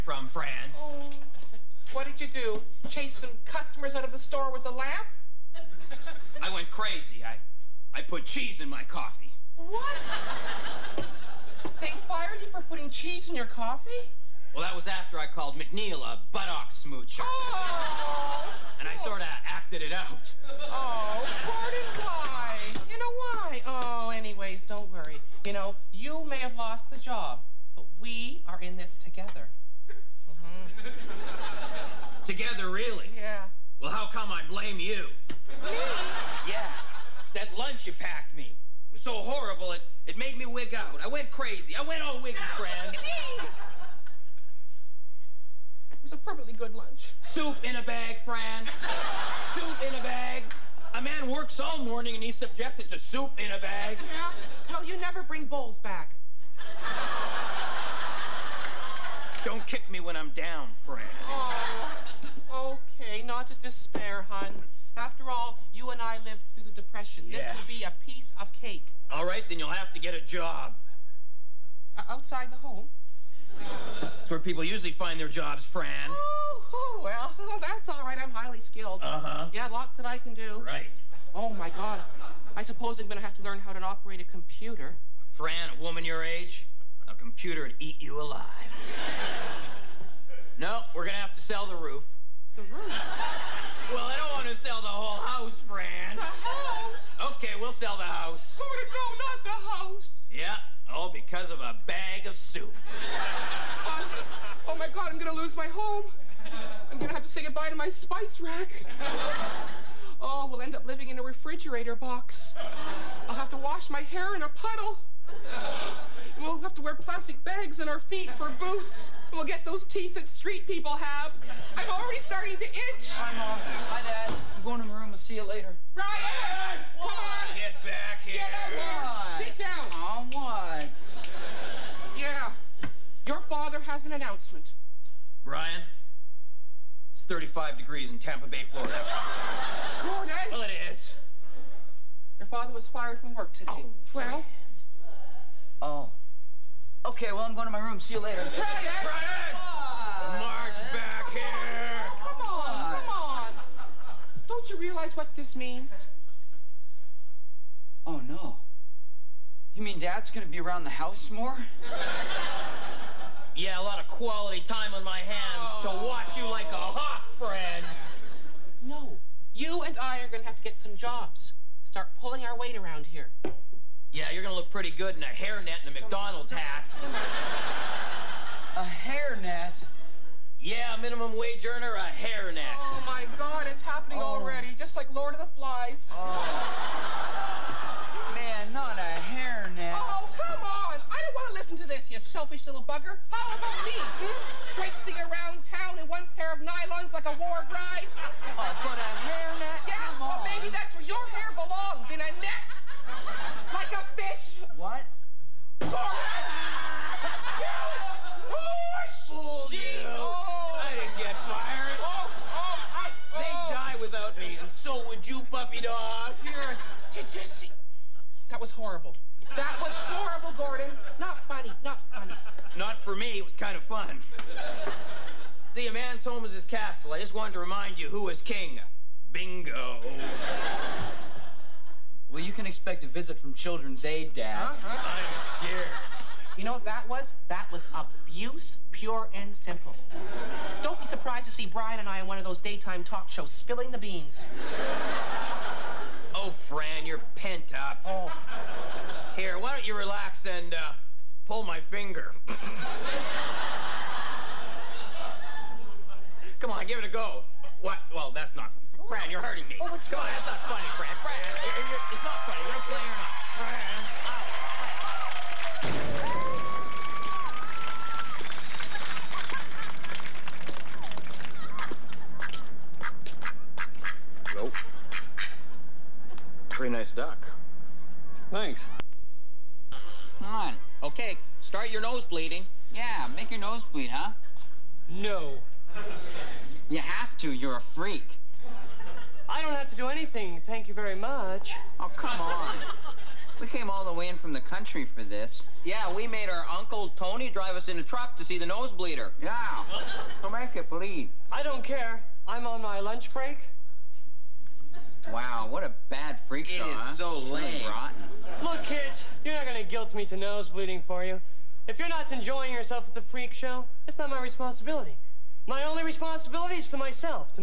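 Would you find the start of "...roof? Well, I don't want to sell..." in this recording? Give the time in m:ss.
1:32.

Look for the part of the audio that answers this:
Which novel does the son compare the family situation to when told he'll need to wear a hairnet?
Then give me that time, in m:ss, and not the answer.
3:05.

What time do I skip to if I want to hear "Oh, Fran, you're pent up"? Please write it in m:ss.
4:06.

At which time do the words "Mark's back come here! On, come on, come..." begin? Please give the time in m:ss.
2:30.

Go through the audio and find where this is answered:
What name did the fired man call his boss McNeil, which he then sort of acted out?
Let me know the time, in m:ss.
0:16.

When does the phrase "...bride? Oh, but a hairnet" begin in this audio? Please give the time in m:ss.
3:17.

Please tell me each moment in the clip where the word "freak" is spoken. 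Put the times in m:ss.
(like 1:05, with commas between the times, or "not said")
4:47, 5:06, 5:13.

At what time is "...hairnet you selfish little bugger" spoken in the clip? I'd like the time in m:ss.
3:09.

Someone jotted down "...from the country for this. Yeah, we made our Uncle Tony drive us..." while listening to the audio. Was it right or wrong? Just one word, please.
right.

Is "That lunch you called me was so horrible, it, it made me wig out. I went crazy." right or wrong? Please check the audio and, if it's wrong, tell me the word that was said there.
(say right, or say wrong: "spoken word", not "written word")
wrong: "packed", not "called".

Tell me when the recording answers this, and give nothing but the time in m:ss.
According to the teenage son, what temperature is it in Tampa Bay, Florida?
2:17.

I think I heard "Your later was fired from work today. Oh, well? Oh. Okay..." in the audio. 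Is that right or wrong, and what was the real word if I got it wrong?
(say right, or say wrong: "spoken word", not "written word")
wrong: "father", not "later".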